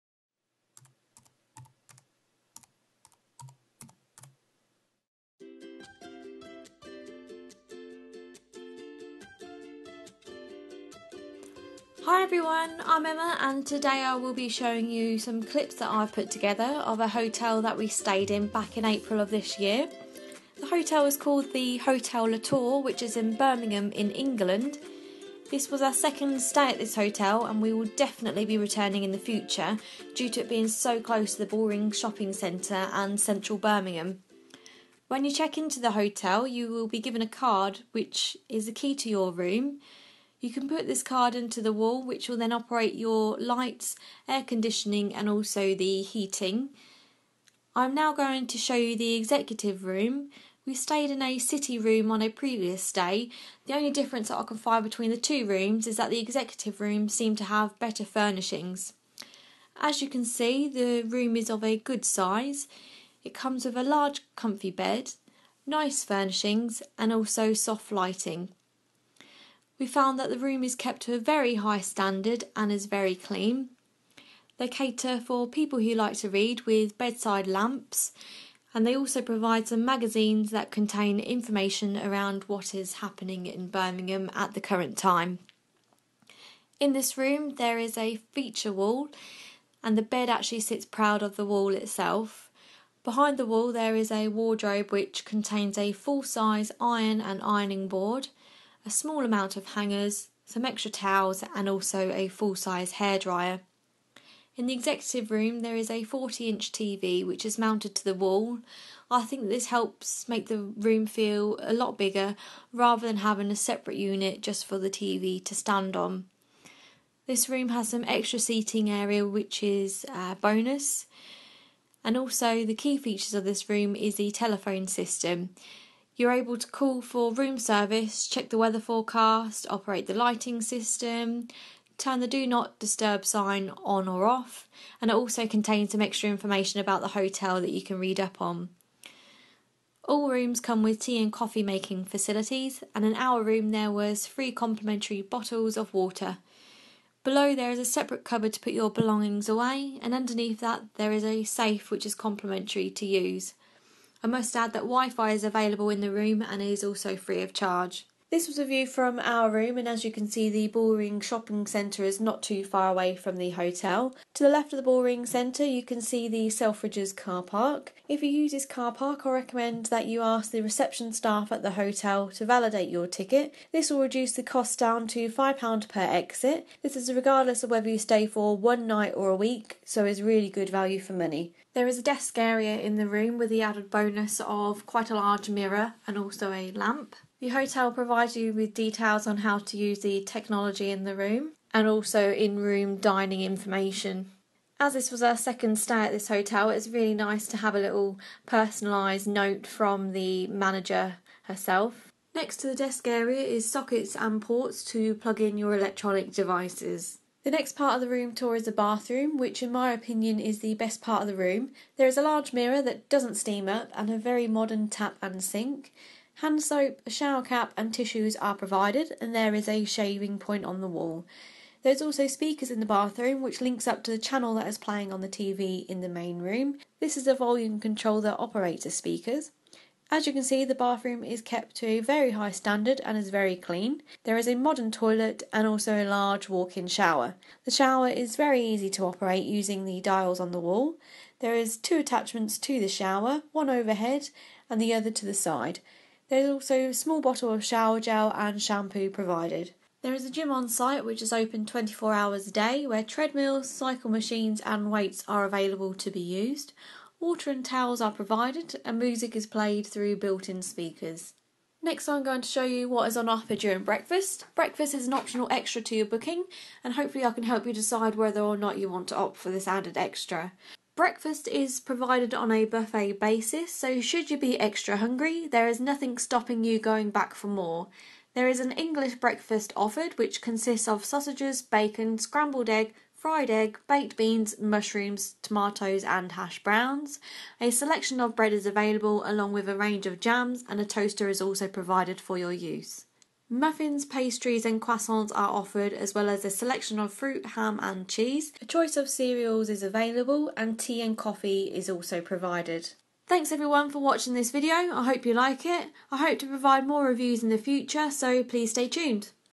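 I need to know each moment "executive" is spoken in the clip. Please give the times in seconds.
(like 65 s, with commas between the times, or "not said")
49 s, 56 s, 104 s.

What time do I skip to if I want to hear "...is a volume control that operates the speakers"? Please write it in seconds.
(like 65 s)
227 s.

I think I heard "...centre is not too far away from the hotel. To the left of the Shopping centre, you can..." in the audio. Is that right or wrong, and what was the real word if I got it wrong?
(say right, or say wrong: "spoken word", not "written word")
wrong: "Bullring", not "Shopping".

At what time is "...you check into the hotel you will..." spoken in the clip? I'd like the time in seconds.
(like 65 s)
35 s.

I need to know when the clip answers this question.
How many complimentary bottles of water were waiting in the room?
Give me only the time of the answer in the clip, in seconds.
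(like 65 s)
144 s.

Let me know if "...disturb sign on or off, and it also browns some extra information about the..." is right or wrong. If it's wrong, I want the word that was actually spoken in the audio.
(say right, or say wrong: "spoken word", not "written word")
wrong: "contains", not "browns".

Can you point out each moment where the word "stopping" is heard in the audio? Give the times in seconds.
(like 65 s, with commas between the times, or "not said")
276 s.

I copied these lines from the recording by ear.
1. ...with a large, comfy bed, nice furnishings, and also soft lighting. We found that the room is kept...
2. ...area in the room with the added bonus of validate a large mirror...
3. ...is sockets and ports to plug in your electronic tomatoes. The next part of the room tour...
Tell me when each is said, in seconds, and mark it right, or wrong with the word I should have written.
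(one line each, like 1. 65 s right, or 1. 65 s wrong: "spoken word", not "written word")
1. 63 s right
2. 182 s wrong: "quite", not "validate"
3. 203 s wrong: "devices", not "tomatoes".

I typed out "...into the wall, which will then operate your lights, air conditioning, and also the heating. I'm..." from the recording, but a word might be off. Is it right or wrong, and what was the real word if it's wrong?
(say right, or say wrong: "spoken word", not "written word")
right.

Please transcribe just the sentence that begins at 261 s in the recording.
Next, I'm going to show you what is on offer during breakfast.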